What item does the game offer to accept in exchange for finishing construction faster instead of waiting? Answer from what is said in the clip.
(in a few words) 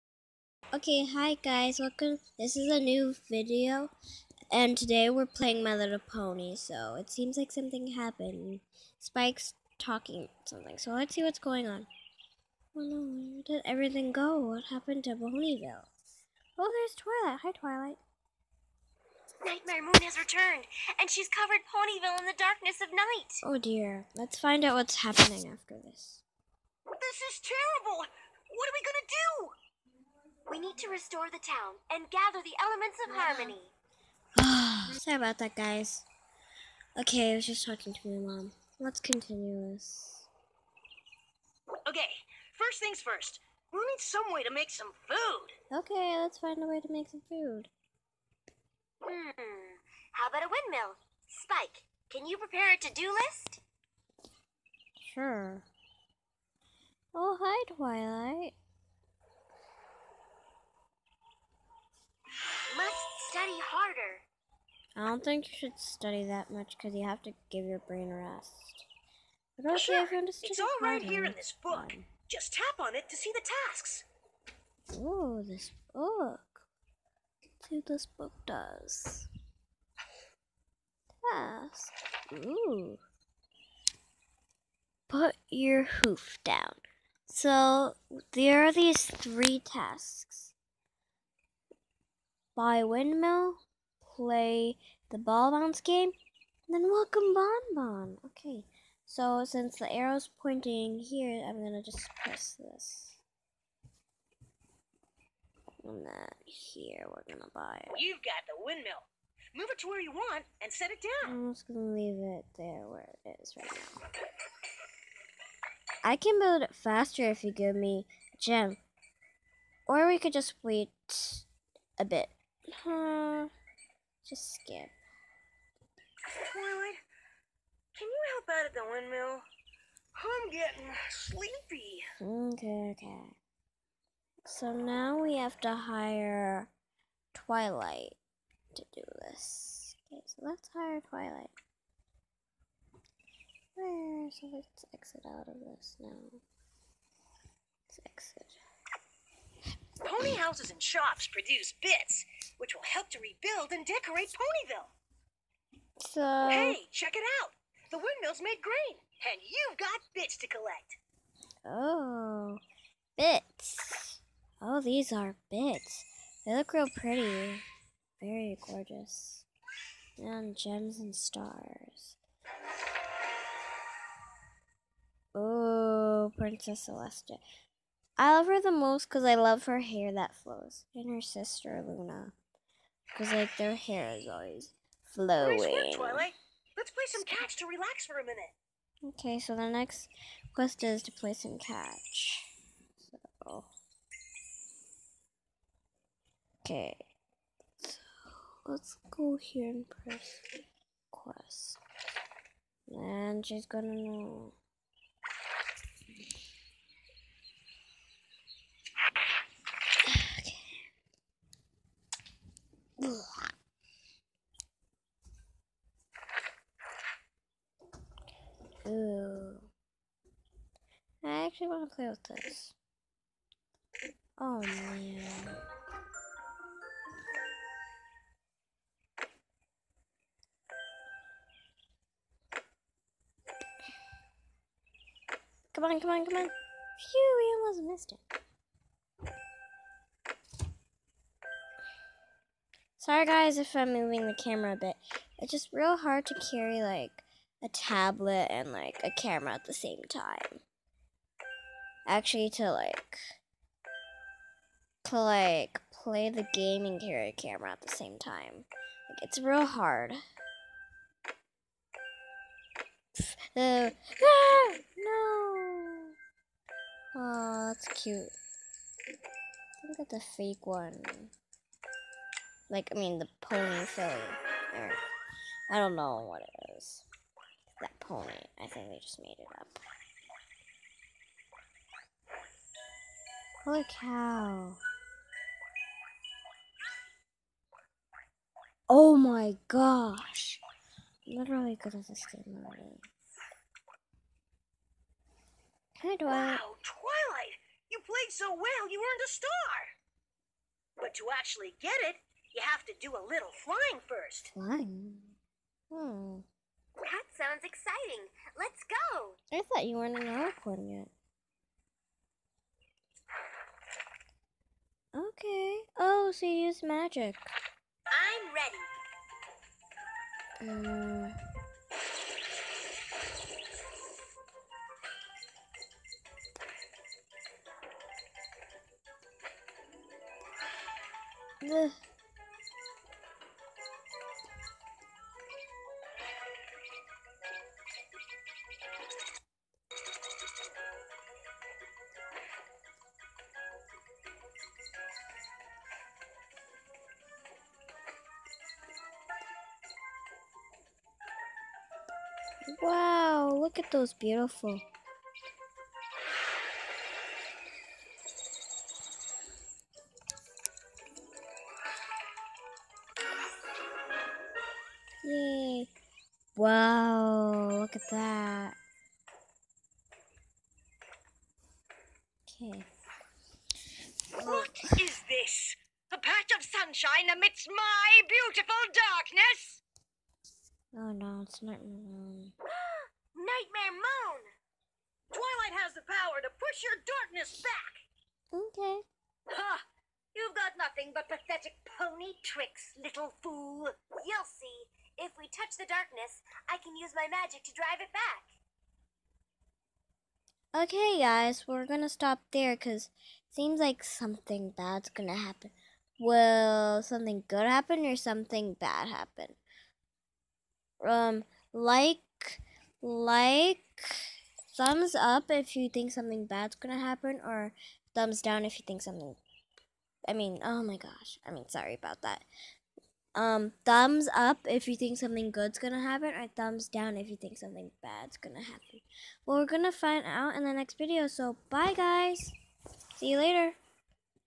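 A gem.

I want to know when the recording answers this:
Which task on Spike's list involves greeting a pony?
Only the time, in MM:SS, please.
01:36.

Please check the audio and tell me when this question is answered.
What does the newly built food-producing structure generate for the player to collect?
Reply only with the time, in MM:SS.
02:37.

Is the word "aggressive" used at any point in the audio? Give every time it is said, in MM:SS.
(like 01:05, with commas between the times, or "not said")
not said.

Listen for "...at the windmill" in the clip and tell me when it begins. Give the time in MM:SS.
02:08.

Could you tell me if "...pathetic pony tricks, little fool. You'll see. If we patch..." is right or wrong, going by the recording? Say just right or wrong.
wrong.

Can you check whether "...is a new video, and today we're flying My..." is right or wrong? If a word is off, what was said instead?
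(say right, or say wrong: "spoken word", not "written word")
wrong: "playing", not "flying".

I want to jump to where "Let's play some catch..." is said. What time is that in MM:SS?
03:06.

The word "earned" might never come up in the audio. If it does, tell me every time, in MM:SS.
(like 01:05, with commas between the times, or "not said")
04:59.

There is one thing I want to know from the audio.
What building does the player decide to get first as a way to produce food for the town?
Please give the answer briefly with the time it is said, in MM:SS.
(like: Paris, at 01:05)
A windmill, at 00:50.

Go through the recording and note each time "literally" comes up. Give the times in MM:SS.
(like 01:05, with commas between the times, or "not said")
04:51.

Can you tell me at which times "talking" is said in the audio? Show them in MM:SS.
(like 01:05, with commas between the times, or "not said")
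00:09, 00:37.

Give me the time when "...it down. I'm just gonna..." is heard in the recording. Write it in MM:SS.
01:50.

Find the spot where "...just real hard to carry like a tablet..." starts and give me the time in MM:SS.
04:05.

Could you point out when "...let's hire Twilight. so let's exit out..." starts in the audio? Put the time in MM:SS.
02:20.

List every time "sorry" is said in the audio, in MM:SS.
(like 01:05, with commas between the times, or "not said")
00:34, 04:02, 07:01.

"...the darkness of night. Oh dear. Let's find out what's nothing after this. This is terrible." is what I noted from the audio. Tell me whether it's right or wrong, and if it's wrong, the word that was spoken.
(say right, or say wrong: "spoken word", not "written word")
wrong: "happening", not "nothing".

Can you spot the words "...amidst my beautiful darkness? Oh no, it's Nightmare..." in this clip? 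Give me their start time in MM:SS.
06:17.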